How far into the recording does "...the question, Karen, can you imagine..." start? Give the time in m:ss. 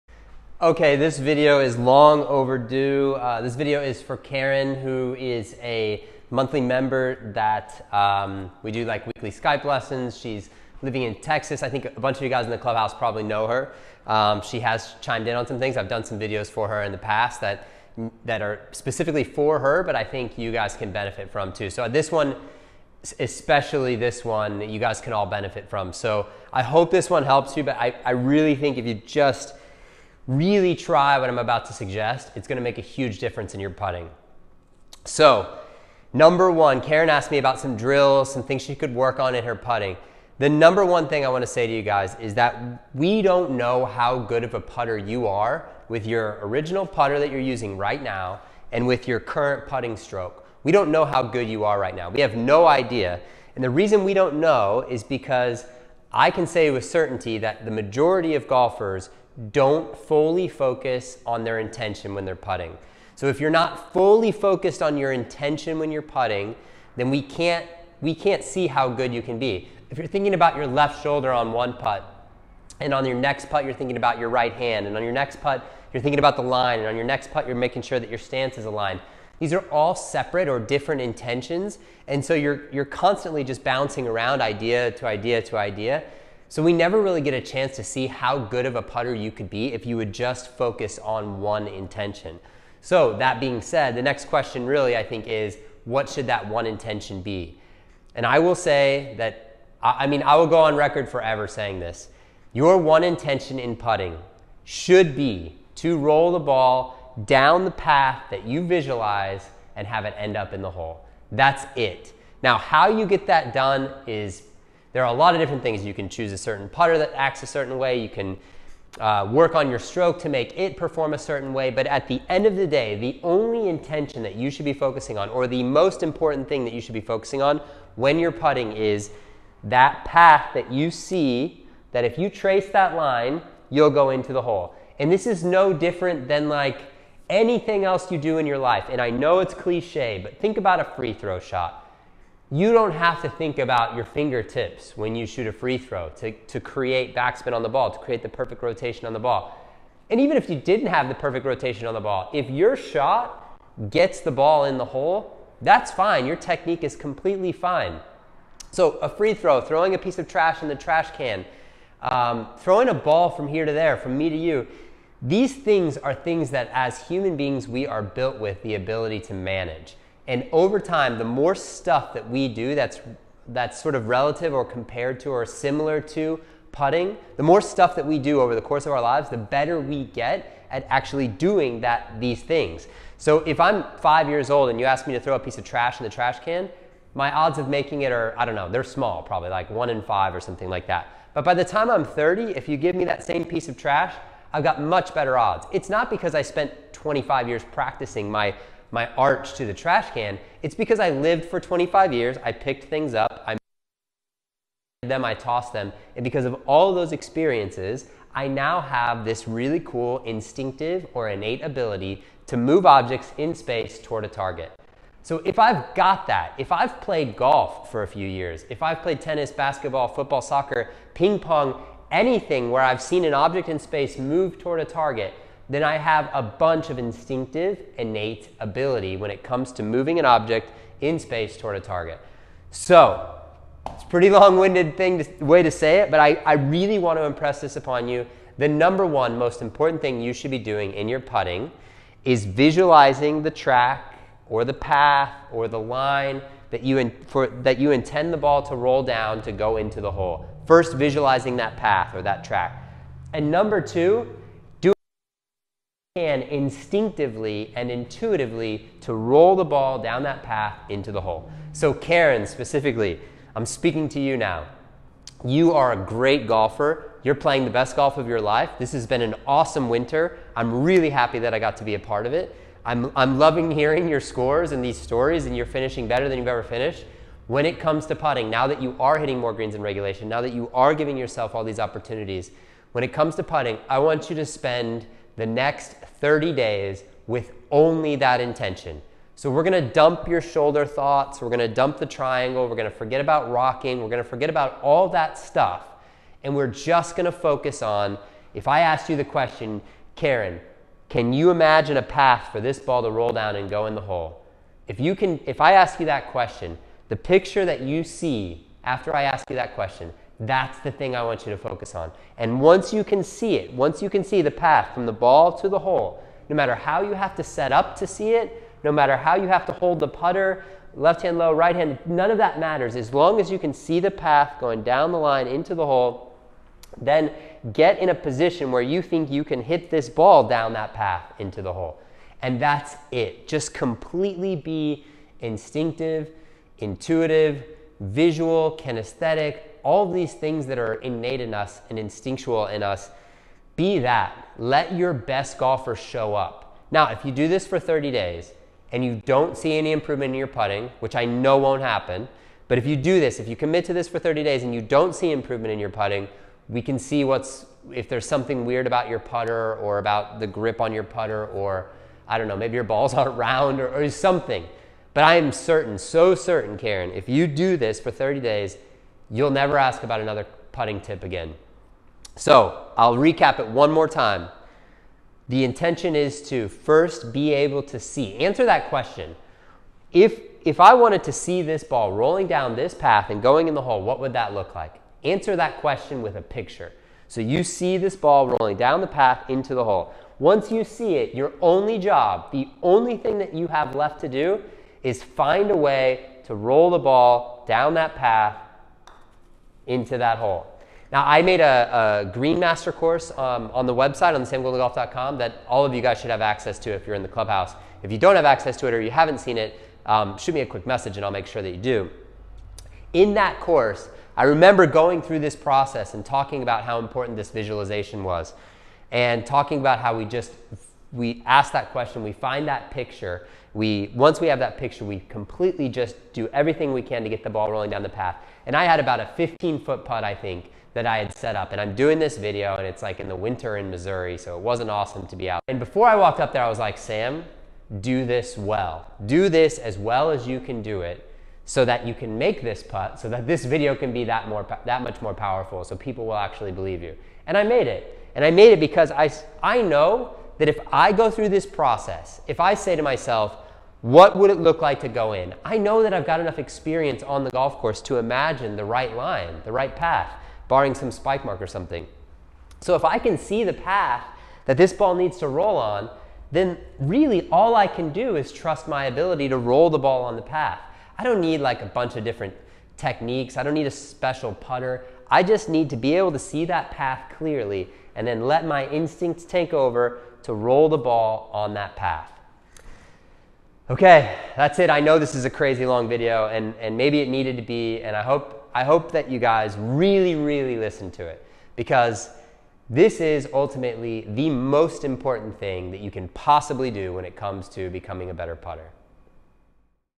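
4:59.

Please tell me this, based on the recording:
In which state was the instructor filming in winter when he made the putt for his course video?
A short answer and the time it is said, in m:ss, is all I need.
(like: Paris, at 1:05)
Missouri, at 7:13.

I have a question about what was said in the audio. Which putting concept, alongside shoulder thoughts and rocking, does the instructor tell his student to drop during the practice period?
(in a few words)
The triangle.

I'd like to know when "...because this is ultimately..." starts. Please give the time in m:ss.
8:11.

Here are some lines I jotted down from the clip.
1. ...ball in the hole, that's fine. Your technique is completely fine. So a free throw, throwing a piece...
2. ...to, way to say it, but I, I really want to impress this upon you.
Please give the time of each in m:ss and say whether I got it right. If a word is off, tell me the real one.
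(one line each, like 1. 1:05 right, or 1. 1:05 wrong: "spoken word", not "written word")
1. 2:34 right
2. 3:55 right.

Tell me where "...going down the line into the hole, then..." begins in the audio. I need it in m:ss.
5:24.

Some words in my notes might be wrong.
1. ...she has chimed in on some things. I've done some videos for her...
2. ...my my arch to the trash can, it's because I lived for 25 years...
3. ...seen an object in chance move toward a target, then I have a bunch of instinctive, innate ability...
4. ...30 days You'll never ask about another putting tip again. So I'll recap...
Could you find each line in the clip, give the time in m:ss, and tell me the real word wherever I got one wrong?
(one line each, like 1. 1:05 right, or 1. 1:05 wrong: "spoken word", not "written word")
1. 0:14 right
2. 3:18 right
3. 3:43 wrong: "space", not "chance"
4. 6:08 right.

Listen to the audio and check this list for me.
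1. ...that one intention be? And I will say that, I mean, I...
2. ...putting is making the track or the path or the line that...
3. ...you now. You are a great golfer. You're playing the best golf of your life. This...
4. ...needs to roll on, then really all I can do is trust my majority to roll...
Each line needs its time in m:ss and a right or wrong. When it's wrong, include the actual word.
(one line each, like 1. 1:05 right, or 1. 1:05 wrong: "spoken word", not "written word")
1. 1:36 right
2. 4:01 wrong: "visualizing", not "making"
3. 4:24 right
4. 7:45 wrong: "ability", not "majority".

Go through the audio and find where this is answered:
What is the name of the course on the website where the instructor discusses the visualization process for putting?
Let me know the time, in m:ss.
6:42.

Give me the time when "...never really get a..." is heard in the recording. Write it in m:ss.
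1:26.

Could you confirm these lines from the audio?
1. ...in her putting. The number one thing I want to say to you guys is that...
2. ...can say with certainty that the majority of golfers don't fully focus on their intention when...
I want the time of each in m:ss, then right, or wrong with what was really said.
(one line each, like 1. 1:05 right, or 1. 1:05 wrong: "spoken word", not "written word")
1. 0:39 right
2. 0:56 right.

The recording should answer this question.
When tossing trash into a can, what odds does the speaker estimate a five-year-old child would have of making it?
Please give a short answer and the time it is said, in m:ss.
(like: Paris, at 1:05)
1 in 5, at 3:09.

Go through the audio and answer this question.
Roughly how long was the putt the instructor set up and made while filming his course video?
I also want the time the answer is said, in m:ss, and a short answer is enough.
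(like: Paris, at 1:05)
15 feet, at 7:09.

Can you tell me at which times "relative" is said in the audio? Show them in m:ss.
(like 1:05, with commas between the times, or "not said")
2:54.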